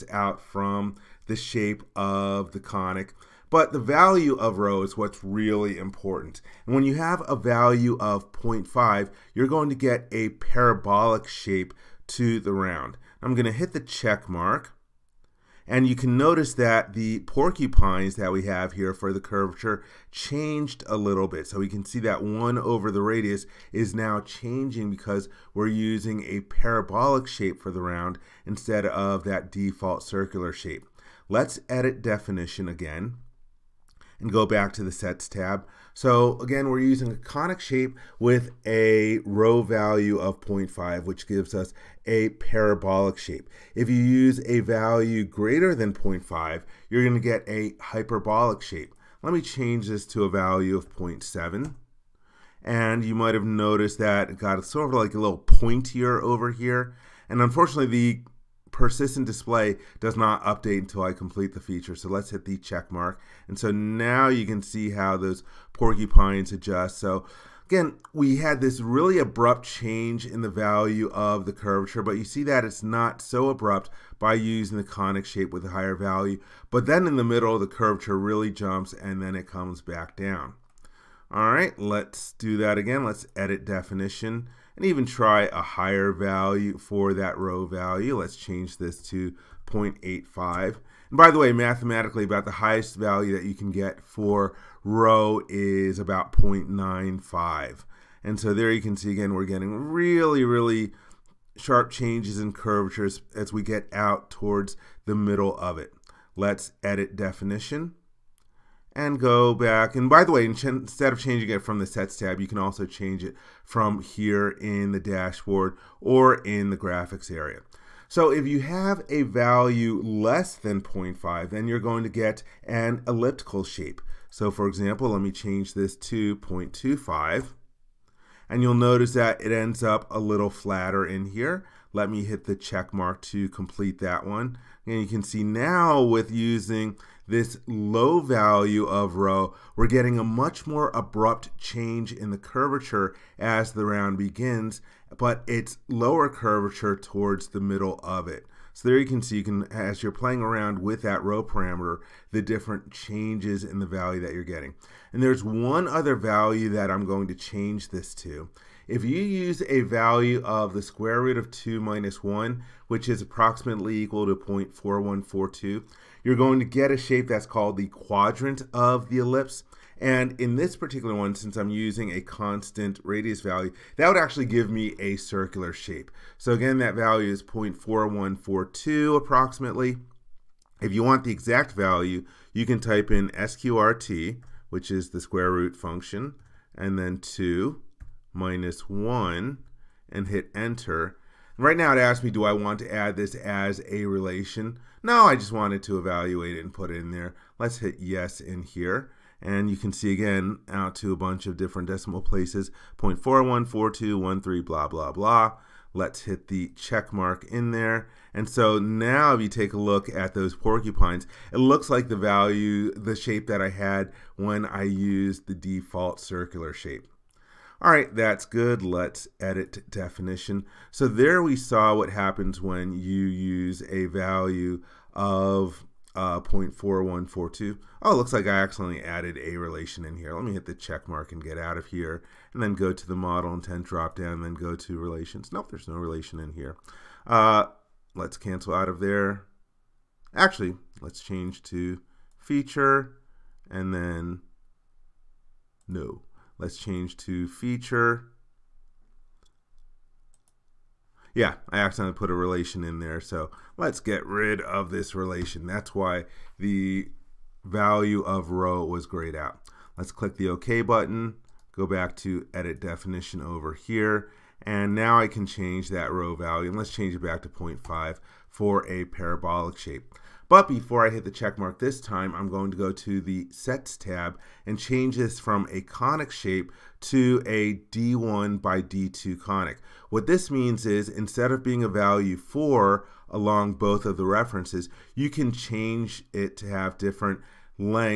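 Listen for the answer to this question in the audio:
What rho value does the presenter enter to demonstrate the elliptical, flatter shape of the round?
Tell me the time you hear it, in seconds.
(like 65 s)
126 s.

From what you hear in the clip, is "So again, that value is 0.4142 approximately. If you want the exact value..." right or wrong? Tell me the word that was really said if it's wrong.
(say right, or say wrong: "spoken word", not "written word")
right.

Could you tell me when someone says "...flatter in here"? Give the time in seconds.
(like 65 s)
130 s.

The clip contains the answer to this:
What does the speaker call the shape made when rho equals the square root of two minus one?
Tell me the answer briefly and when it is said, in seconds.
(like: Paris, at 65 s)
quadrant of the ellipse, at 167 s.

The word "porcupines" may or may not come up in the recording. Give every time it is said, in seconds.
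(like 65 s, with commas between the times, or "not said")
17 s, 65 s, 210 s.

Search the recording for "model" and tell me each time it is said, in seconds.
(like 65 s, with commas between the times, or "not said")
233 s.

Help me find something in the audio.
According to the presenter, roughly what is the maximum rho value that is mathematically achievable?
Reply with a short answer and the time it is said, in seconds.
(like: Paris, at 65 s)
0.95, at 96 s.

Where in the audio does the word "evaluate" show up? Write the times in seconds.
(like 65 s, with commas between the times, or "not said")
195 s.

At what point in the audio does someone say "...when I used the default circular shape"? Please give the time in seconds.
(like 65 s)
214 s.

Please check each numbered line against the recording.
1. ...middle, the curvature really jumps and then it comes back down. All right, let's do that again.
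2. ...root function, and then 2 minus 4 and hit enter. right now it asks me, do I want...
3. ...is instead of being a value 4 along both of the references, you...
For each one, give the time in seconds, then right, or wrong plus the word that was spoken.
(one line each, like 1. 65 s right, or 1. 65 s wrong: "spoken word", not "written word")
1. 77 s right
2. 185 s wrong: "1", not "4"
3. 280 s right.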